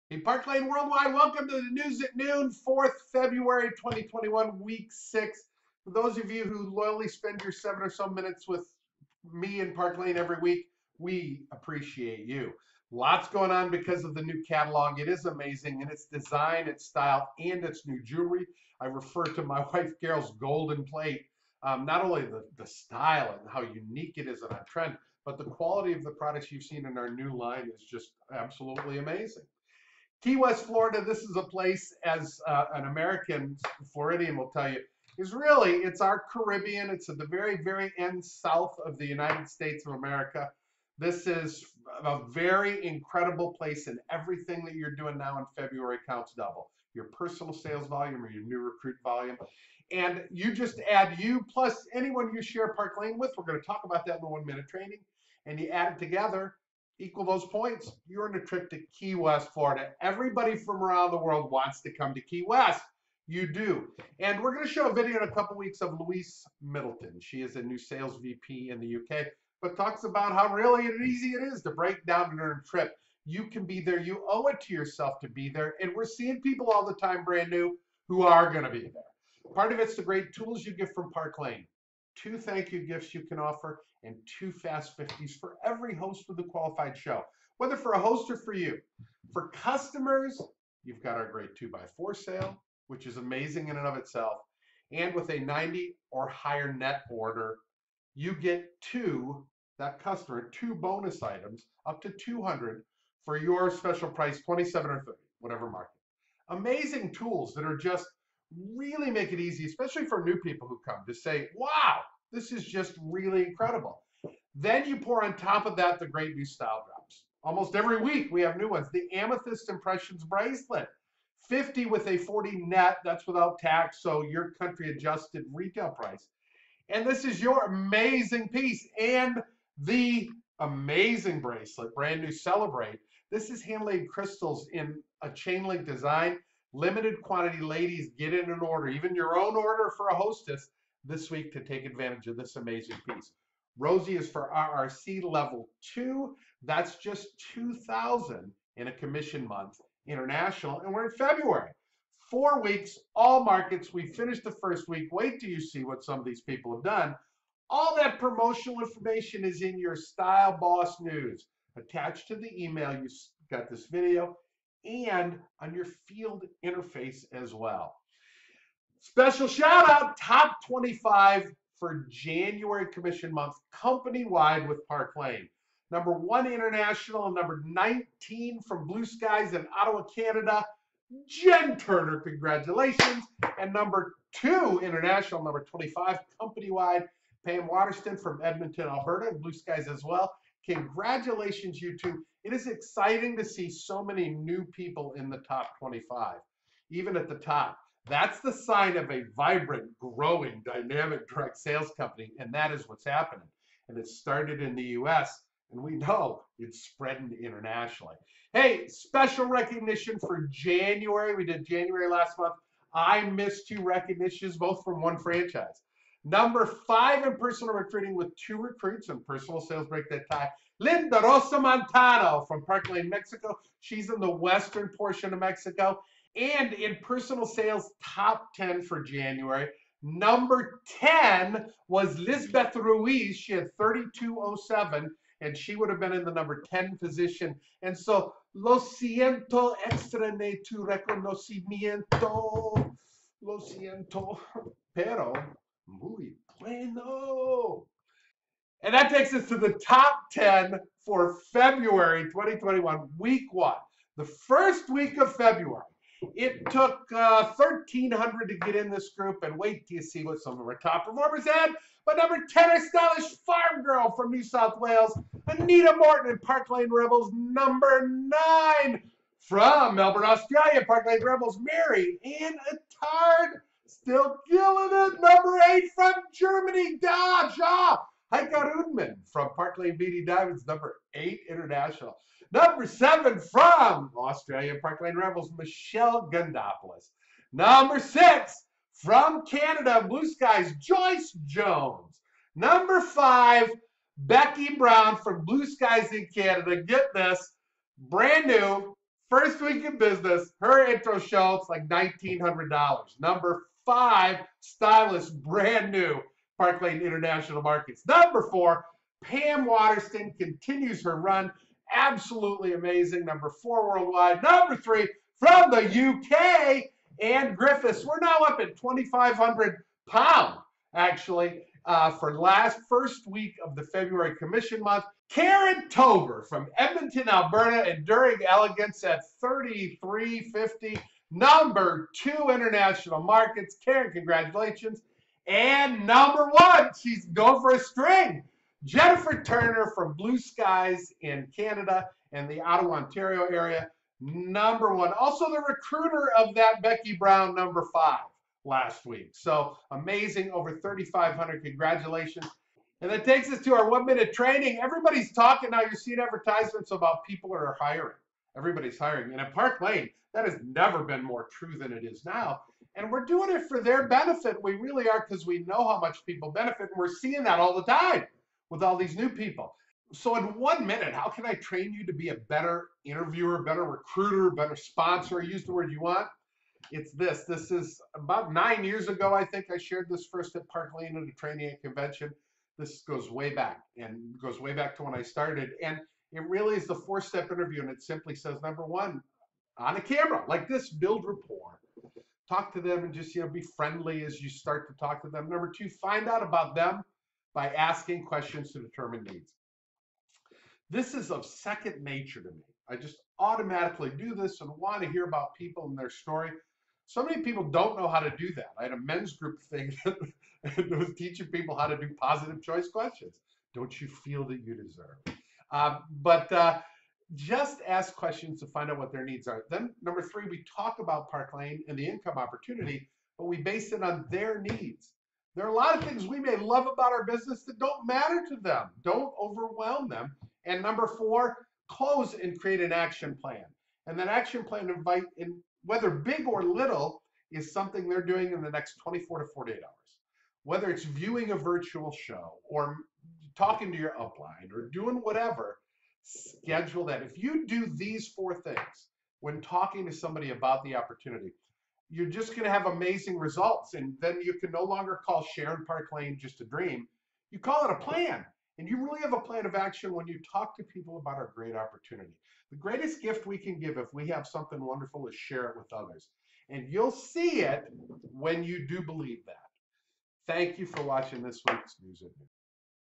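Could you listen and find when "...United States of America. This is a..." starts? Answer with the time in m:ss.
0:39.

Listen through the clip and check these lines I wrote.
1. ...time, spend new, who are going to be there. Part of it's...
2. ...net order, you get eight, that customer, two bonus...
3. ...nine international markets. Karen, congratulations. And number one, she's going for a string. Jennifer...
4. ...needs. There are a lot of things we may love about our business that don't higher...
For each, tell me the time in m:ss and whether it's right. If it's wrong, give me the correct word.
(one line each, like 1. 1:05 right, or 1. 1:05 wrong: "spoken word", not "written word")
1. 1:16 wrong: "brand", not "spend"
2. 1:36 wrong: "two", not "eight"
3. 5:32 wrong: "two", not "nine"
4. 7:04 wrong: "matter", not "higher".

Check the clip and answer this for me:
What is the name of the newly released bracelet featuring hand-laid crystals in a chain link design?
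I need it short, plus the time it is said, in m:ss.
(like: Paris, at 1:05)
Celebrate, at 2:12.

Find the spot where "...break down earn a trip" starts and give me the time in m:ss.
1:11.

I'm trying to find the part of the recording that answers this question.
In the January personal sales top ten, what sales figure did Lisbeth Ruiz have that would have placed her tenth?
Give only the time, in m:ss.
3:53.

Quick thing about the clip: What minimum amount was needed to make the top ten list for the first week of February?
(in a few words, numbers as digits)
1,300.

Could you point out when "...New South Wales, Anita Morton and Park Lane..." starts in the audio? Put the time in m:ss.
4:24.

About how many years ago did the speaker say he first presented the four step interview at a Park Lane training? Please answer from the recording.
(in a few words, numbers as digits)
9.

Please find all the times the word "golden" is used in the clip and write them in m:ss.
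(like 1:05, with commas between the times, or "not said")
0:20.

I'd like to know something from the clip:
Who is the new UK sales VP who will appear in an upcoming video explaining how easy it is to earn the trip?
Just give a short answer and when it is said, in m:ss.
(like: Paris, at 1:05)
Louise Middleton, at 1:05.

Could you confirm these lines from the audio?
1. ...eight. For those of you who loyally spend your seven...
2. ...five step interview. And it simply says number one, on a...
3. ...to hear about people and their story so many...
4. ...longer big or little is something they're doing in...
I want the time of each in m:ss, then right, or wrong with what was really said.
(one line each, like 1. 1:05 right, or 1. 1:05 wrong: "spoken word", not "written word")
1. 0:04 wrong: "six", not "eight"
2. 6:26 wrong: "four", not "five"
3. 6:45 right
4. 7:15 wrong: "whether", not "longer".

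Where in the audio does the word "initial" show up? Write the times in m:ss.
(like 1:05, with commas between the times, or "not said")
not said.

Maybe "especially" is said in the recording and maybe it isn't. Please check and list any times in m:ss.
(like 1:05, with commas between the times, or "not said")
1:49.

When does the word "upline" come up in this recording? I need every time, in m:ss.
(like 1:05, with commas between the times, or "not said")
7:24.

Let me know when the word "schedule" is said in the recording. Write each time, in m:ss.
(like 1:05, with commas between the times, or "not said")
7:26.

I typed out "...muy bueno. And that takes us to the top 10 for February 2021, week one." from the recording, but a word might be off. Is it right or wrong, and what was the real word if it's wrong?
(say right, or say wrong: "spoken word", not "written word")
right.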